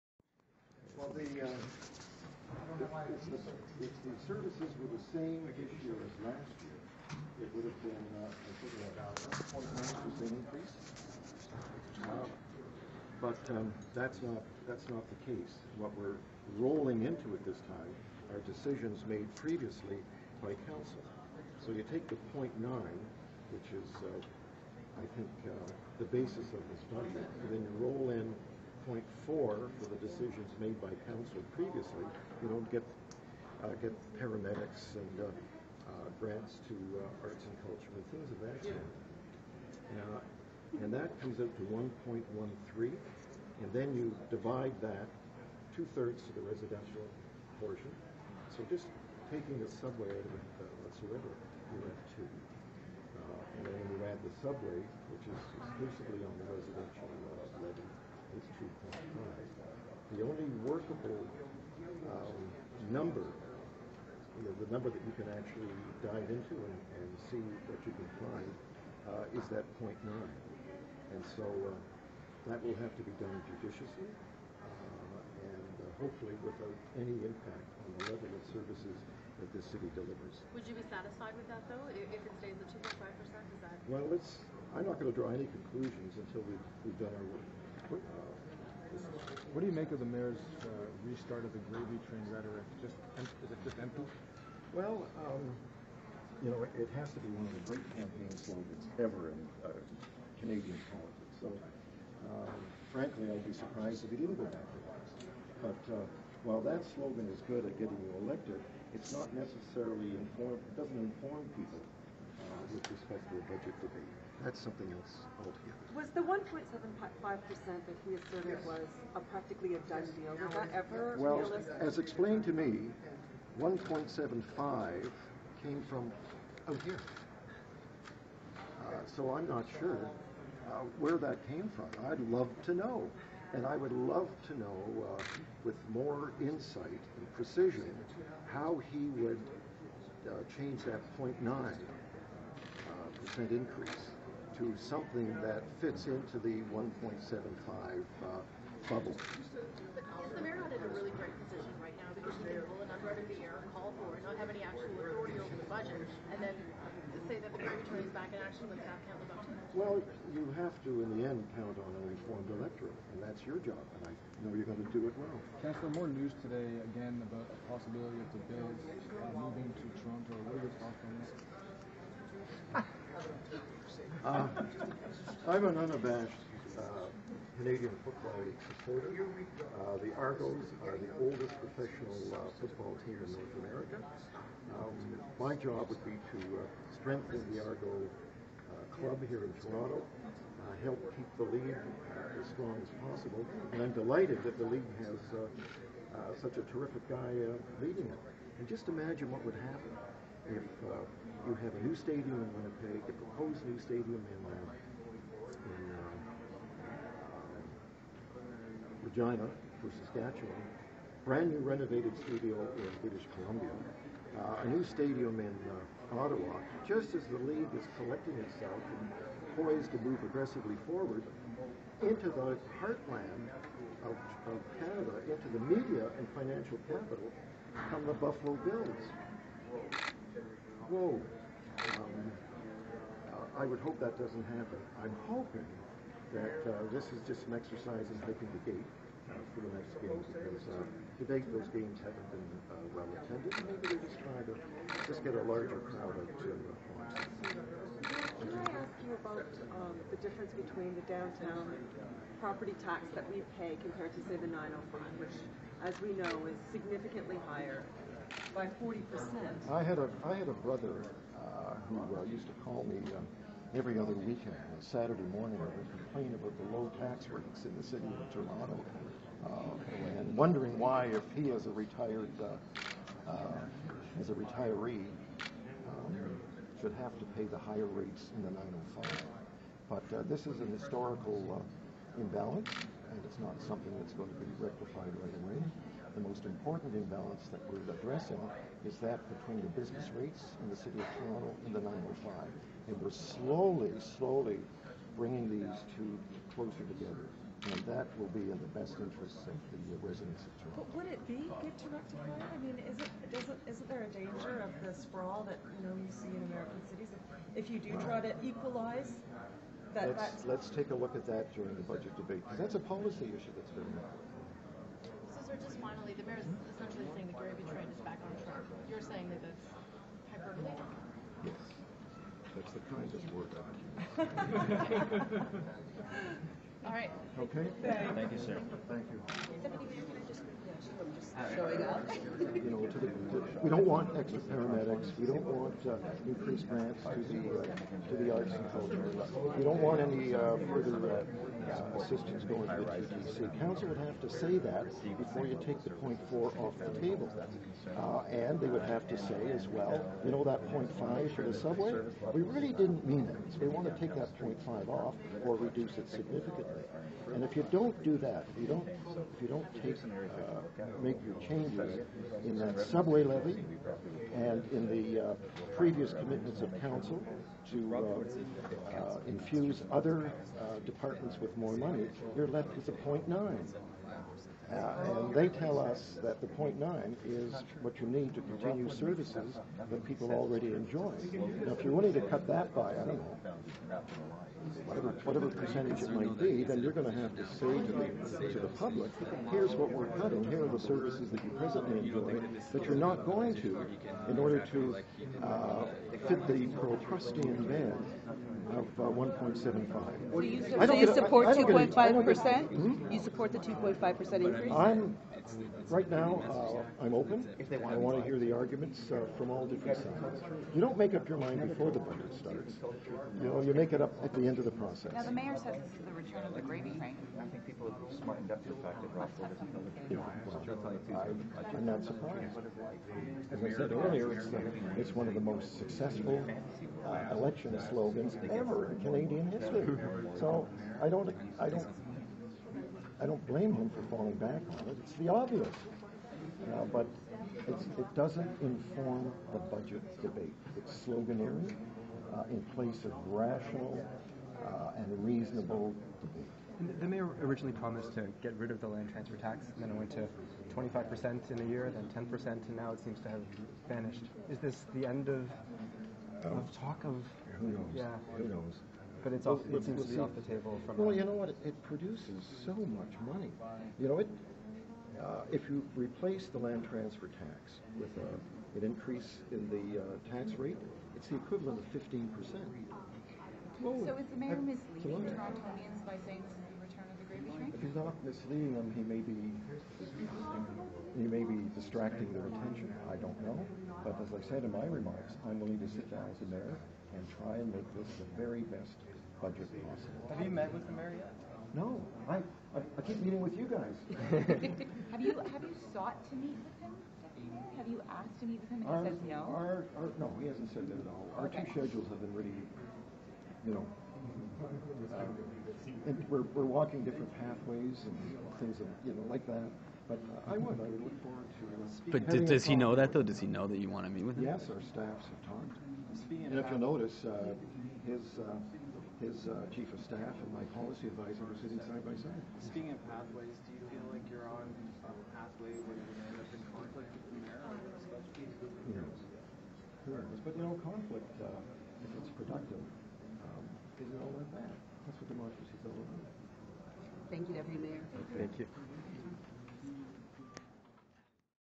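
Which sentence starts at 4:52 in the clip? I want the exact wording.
And we're slowly, slowly bringing these two closer together.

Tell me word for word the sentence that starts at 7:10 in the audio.
So I don't, I don't I don't blame him for falling back on it.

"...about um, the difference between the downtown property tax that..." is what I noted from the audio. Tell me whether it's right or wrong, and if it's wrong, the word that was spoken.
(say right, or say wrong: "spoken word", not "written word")
right.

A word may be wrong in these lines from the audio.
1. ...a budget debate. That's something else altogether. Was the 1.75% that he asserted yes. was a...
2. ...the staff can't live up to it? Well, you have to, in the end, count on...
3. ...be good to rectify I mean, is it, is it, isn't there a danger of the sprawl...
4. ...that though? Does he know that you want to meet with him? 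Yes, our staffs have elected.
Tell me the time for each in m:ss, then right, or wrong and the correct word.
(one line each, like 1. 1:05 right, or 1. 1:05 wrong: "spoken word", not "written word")
1. 1:53 right
2. 2:38 right
3. 5:01 right
4. 8:32 wrong: "talked", not "elected".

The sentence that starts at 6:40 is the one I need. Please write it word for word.
So you, so you support 2.5%?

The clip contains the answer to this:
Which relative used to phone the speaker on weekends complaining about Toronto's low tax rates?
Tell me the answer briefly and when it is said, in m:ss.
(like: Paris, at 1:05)
brother, at 4:20.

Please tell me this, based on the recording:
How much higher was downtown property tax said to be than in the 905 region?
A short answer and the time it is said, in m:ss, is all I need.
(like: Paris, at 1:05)
40%, at 4:18.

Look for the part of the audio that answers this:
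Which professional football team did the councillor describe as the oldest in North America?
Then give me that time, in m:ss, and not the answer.
2:59.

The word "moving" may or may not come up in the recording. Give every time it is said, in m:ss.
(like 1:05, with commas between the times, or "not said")
2:49.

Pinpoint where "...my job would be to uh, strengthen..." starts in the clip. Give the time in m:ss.
3:05.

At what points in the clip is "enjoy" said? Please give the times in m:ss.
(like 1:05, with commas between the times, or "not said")
6:20, 6:31.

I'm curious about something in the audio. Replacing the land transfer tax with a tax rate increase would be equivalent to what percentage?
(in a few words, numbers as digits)
15%.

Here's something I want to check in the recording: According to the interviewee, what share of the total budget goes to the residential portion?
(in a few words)
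two-thirds.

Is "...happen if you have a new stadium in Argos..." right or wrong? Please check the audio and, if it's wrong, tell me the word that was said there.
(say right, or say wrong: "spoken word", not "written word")
wrong: "Winnipeg", not "Argos".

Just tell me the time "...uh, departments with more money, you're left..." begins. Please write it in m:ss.
6:10.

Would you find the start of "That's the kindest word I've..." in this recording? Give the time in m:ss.
5:22.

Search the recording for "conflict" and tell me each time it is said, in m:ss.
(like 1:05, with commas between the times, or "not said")
8:46, 8:50.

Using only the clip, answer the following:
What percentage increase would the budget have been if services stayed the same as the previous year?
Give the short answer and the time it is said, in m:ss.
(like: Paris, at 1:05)
1.9%, at 0:09.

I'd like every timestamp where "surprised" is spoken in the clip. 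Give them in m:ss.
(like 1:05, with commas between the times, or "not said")
1:43, 7:02.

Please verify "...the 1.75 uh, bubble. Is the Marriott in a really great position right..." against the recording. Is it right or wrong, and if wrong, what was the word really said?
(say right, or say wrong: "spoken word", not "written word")
right.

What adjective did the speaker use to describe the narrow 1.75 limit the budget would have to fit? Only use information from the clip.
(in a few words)
Procrustean.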